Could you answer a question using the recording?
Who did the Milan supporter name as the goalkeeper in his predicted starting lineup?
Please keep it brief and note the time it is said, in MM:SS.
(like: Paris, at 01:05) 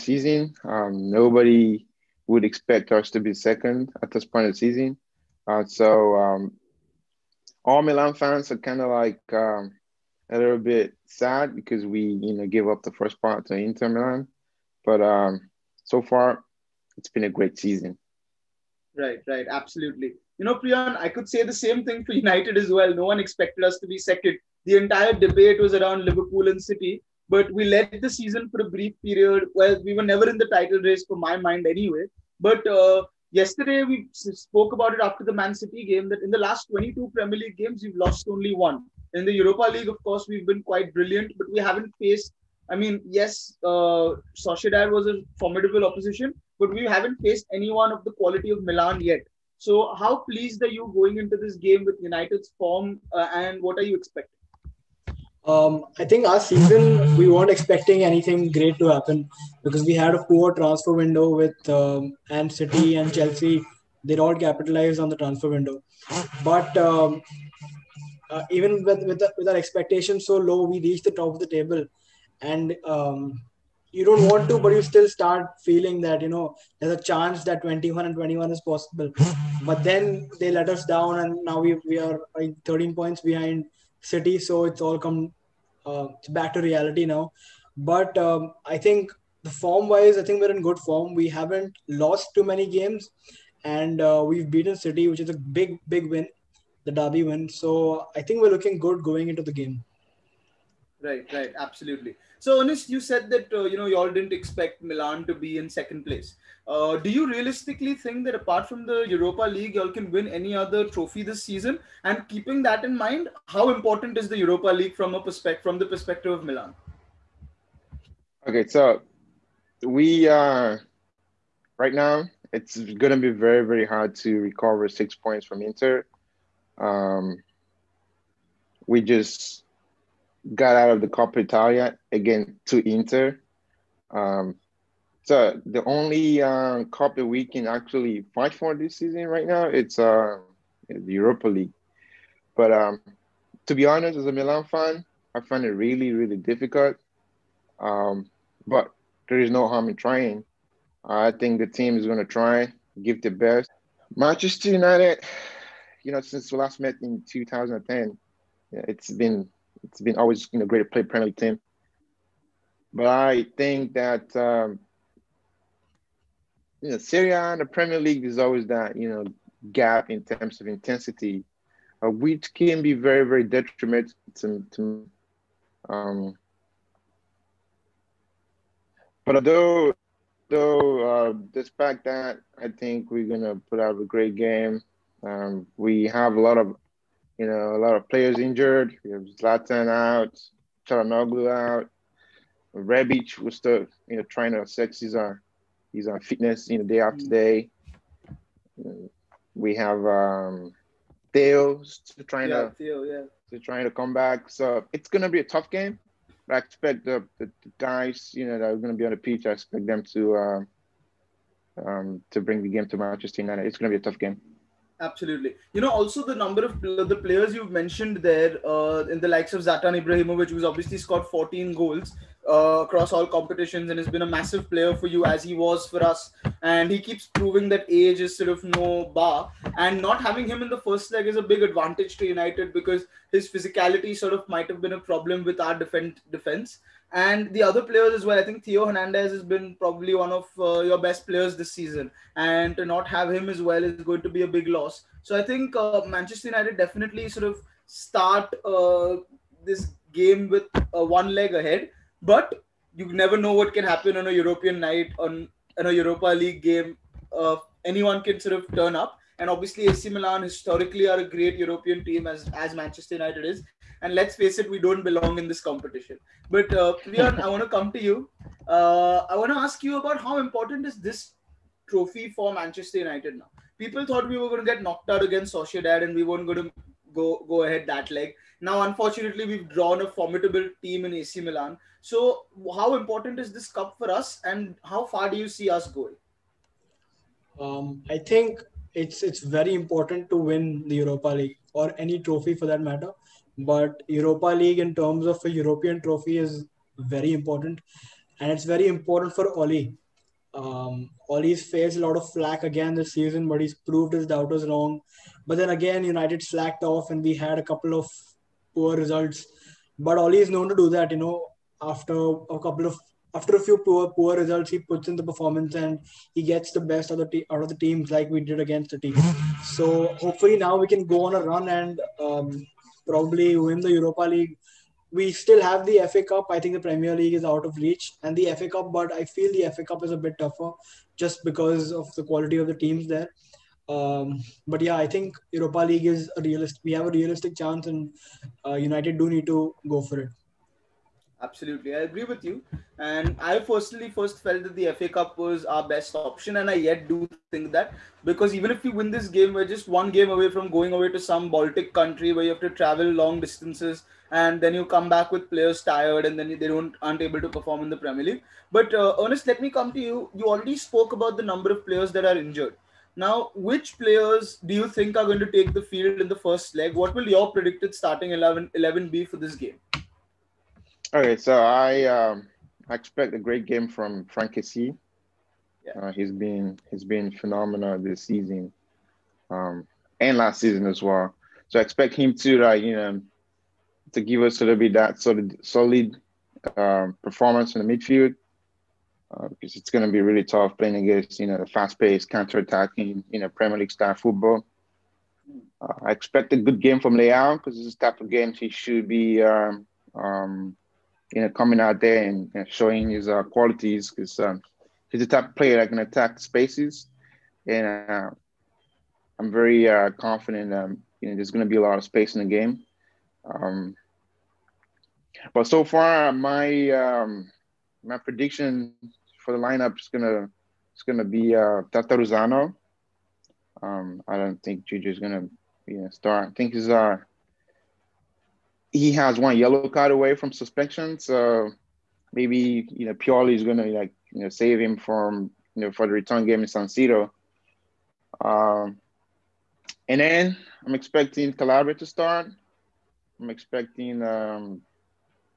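Tatarusanu, at 07:01.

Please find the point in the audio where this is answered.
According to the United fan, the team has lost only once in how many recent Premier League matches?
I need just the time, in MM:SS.
00:36.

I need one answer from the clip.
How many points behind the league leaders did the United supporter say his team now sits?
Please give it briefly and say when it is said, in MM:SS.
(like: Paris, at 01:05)
13, at 01:22.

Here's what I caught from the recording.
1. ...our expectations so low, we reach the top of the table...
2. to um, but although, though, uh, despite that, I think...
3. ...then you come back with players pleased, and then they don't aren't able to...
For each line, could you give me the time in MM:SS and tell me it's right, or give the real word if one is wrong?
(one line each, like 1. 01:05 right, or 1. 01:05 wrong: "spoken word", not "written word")
1. 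01:09 right
2. 02:54 right
3. 05:54 wrong: "tired", not "pleased".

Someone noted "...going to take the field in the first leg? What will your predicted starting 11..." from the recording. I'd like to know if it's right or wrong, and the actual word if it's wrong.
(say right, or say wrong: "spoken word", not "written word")
right.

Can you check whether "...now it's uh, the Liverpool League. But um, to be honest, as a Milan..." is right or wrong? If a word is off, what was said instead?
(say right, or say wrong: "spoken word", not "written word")
wrong: "Europa", not "Liverpool".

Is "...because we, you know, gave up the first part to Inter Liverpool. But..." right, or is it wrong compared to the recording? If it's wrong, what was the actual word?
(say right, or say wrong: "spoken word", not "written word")
wrong: "Milan", not "Liverpool".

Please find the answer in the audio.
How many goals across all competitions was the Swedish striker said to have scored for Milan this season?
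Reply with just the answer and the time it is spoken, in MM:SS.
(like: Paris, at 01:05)
14, at 03:41.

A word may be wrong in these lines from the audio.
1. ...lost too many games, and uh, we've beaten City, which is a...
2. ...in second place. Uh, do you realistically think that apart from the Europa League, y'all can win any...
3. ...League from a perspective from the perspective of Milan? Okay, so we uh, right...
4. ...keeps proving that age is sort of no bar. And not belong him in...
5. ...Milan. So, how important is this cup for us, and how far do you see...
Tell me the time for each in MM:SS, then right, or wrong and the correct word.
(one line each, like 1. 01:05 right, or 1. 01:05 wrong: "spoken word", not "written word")
1. 01:32 right
2. 01:45 right
3. 01:54 right
4. 03:47 wrong: "having", not "belong"
5. 04:41 right.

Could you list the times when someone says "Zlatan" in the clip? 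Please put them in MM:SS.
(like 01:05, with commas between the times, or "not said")
03:09, 03:39.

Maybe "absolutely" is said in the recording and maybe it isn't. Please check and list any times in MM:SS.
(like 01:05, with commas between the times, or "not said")
00:19, 01:41, 03:35, 05:41.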